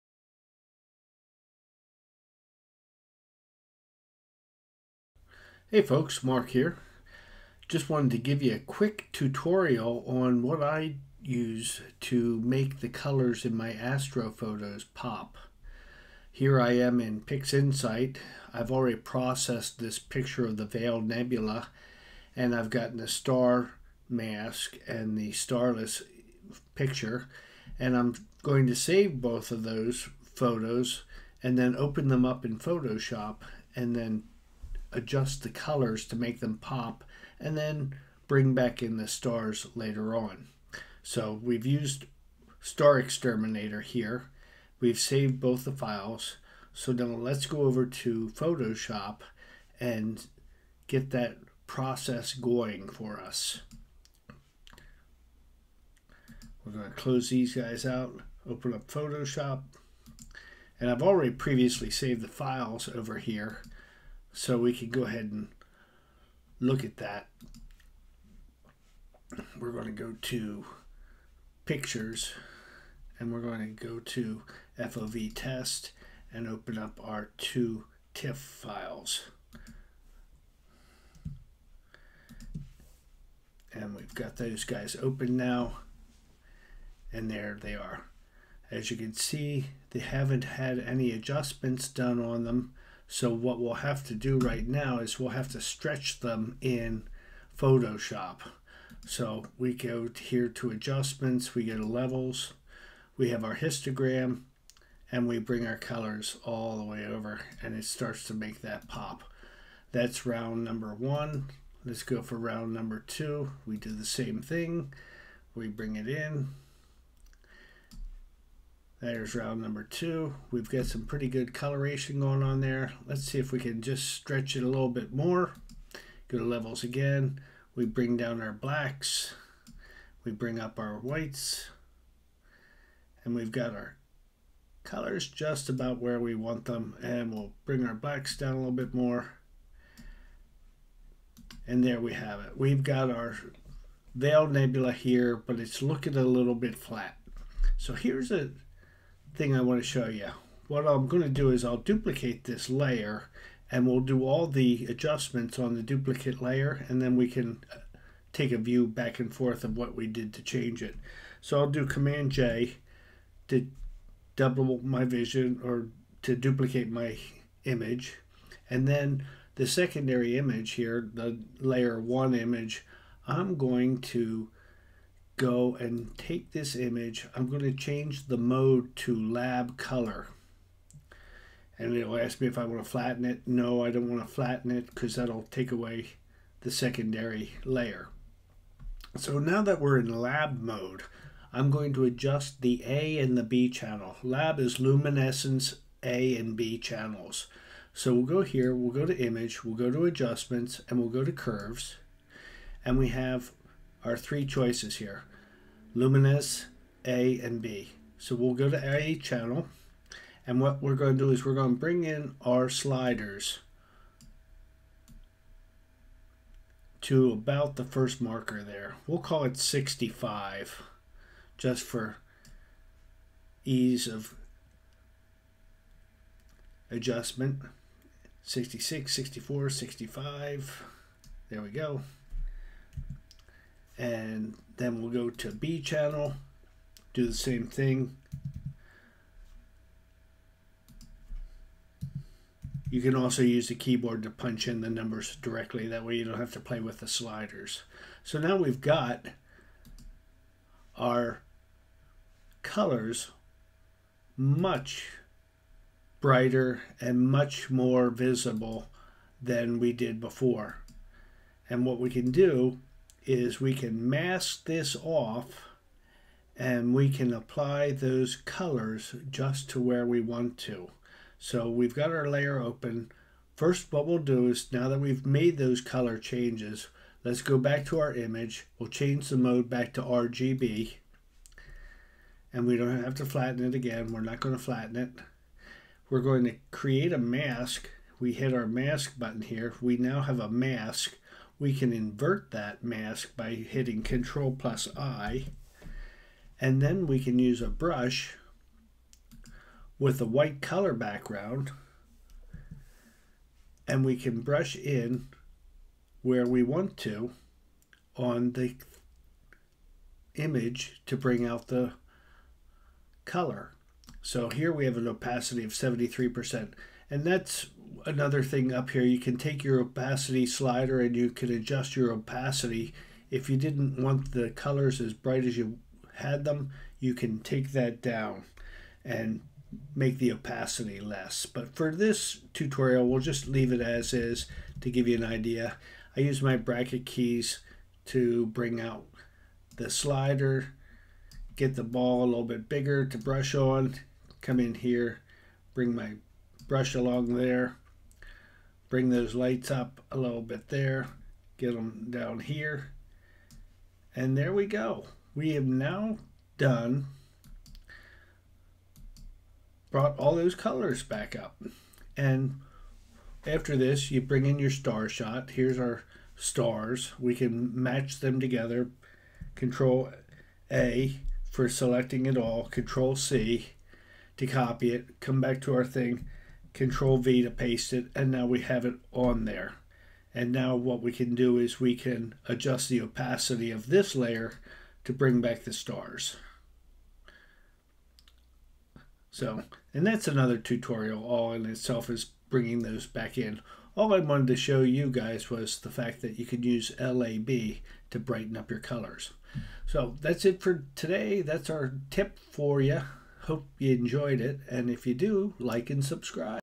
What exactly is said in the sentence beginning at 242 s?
You can also use the keyboard to punch in the numbers directly.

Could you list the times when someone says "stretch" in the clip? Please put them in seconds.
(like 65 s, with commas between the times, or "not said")
95 s, 124 s.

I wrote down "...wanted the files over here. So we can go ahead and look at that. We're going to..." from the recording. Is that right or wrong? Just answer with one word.
wrong.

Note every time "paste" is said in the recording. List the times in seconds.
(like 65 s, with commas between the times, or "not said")
377 s.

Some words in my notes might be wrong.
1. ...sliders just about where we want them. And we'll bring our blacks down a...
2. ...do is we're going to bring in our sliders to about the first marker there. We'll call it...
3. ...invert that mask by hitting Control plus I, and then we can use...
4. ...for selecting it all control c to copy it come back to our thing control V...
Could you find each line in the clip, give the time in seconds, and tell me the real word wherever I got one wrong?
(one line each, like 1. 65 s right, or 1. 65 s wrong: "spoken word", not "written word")
1. 134 s wrong: "colors", not "sliders"
2. 211 s right
3. 291 s right
4. 371 s right.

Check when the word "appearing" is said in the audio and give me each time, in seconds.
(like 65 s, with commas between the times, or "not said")
not said.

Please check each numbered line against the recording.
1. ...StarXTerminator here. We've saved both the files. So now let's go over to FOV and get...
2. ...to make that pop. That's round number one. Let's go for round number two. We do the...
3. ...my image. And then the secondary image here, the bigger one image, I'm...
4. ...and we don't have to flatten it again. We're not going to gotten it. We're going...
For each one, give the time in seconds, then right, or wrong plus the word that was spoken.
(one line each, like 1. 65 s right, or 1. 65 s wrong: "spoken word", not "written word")
1. 42 s wrong: "Photoshop", not "FOV"
2. 108 s right
3. 166 s wrong: "layer", not "bigger"
4. 282 s wrong: "flatten", not "gotten".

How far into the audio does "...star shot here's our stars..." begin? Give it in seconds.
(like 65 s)
364 s.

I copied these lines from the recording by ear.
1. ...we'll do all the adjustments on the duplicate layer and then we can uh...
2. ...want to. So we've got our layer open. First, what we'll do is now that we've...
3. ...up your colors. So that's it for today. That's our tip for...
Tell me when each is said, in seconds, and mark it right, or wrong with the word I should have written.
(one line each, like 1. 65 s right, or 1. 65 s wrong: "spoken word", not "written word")
1. 153 s right
2. 270 s right
3. 398 s right.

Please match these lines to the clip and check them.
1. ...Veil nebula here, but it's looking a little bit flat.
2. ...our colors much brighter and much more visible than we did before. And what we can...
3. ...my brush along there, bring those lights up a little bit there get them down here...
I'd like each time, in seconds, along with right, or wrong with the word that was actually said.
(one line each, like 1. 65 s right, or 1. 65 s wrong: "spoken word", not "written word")
1. 144 s right
2. 250 s right
3. 345 s right.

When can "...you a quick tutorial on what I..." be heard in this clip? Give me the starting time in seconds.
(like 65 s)
8 s.